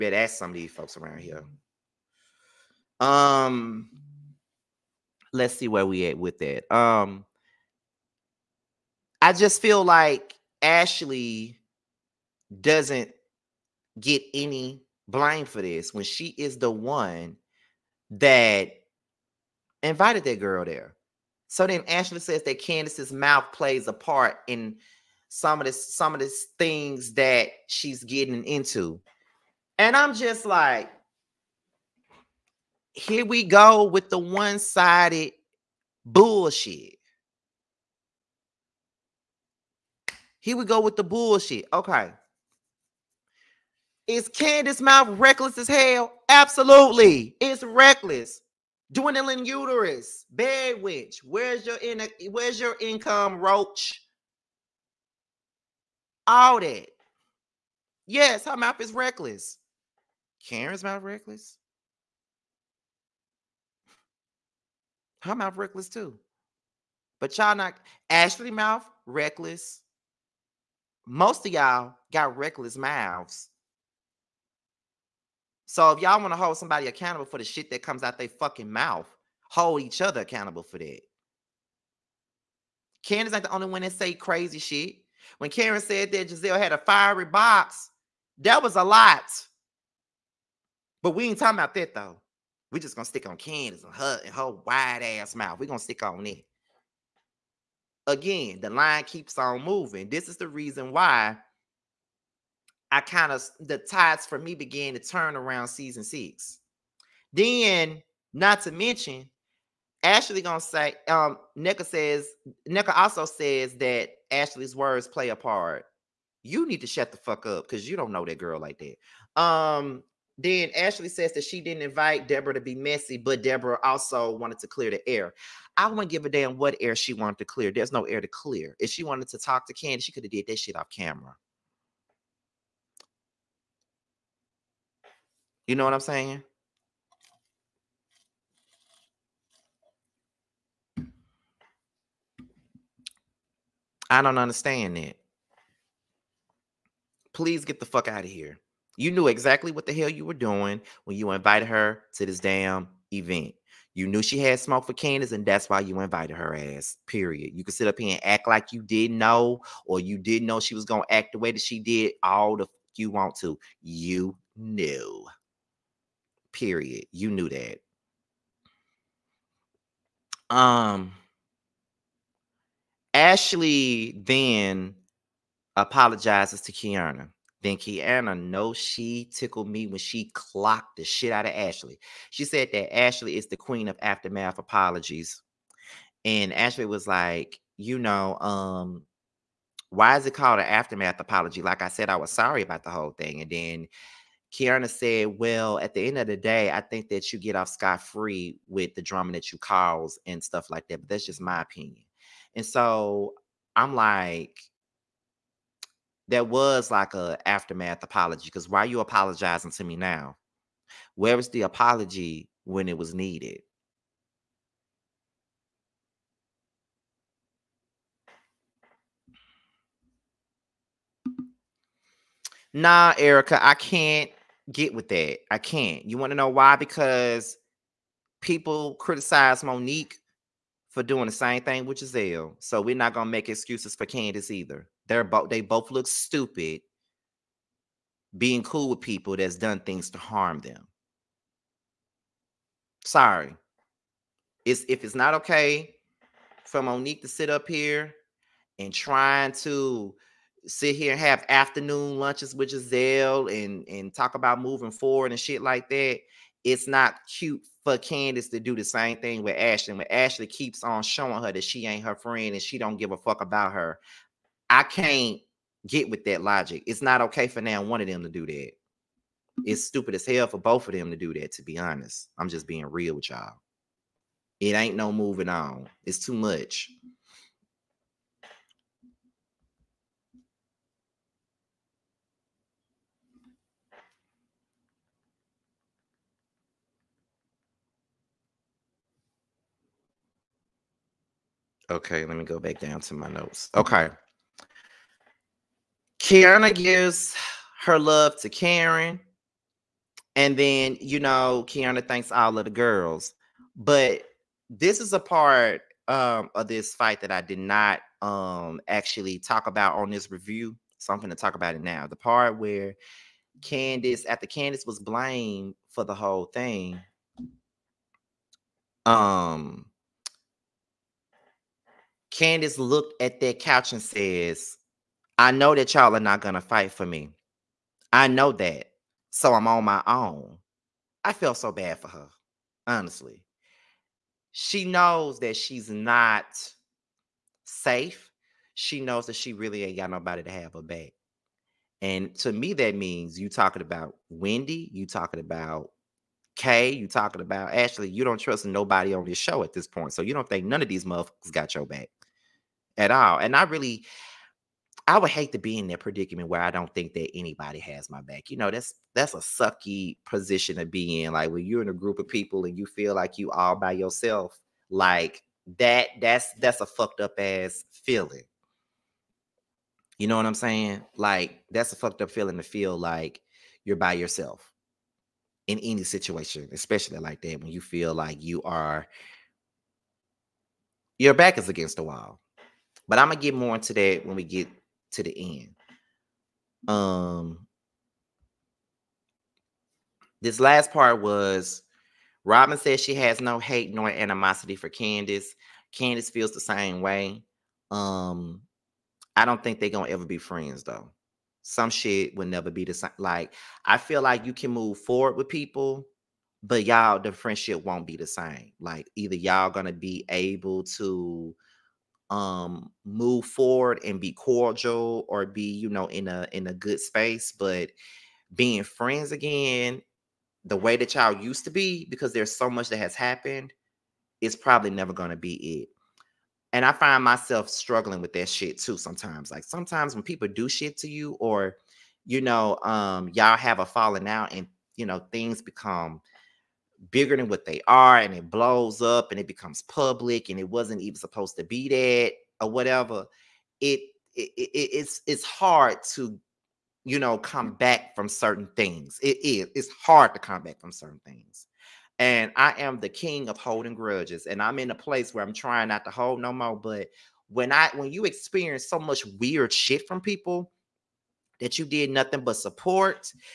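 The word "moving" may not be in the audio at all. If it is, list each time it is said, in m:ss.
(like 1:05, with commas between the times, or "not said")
1:39, 4:14, 4:35.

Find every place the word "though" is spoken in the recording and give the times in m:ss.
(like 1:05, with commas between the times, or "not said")
1:31, 6:40.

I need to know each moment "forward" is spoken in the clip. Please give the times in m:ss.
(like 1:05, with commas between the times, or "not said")
4:14, 6:44, 6:53.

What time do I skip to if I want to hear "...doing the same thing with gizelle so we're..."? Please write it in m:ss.
3:51.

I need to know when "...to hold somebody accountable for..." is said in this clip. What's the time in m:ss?
1:16.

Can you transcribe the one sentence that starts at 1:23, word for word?
Karen's not the only one that say crazy shit.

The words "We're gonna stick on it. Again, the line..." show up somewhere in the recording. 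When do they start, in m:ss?
1:35.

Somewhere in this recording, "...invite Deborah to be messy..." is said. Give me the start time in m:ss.
2:01.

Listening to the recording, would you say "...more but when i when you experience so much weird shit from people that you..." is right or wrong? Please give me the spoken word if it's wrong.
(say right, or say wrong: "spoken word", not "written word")
right.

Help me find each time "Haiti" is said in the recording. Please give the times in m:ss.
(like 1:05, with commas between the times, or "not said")
not said.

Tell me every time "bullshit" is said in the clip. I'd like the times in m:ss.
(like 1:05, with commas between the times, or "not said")
0:36, 0:41.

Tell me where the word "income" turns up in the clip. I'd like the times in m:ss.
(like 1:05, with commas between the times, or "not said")
0:52.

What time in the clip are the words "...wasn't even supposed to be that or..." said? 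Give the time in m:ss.
7:20.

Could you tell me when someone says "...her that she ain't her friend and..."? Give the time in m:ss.
4:21.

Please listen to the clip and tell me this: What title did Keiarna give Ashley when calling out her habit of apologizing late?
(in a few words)
Queen of aftermath apologies.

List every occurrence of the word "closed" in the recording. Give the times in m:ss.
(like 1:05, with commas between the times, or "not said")
not said.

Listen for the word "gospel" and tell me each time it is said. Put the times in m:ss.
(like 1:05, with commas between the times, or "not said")
not said.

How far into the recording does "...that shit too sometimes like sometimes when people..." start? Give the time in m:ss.
7:08.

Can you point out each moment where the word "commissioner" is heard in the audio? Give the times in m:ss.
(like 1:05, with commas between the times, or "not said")
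not said.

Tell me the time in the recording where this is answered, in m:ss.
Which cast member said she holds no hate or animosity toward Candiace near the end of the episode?
6:32.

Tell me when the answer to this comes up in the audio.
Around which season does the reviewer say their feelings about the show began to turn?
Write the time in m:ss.
1:45.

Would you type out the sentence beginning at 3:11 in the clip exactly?
Like I said, I was sorry about the whole thing.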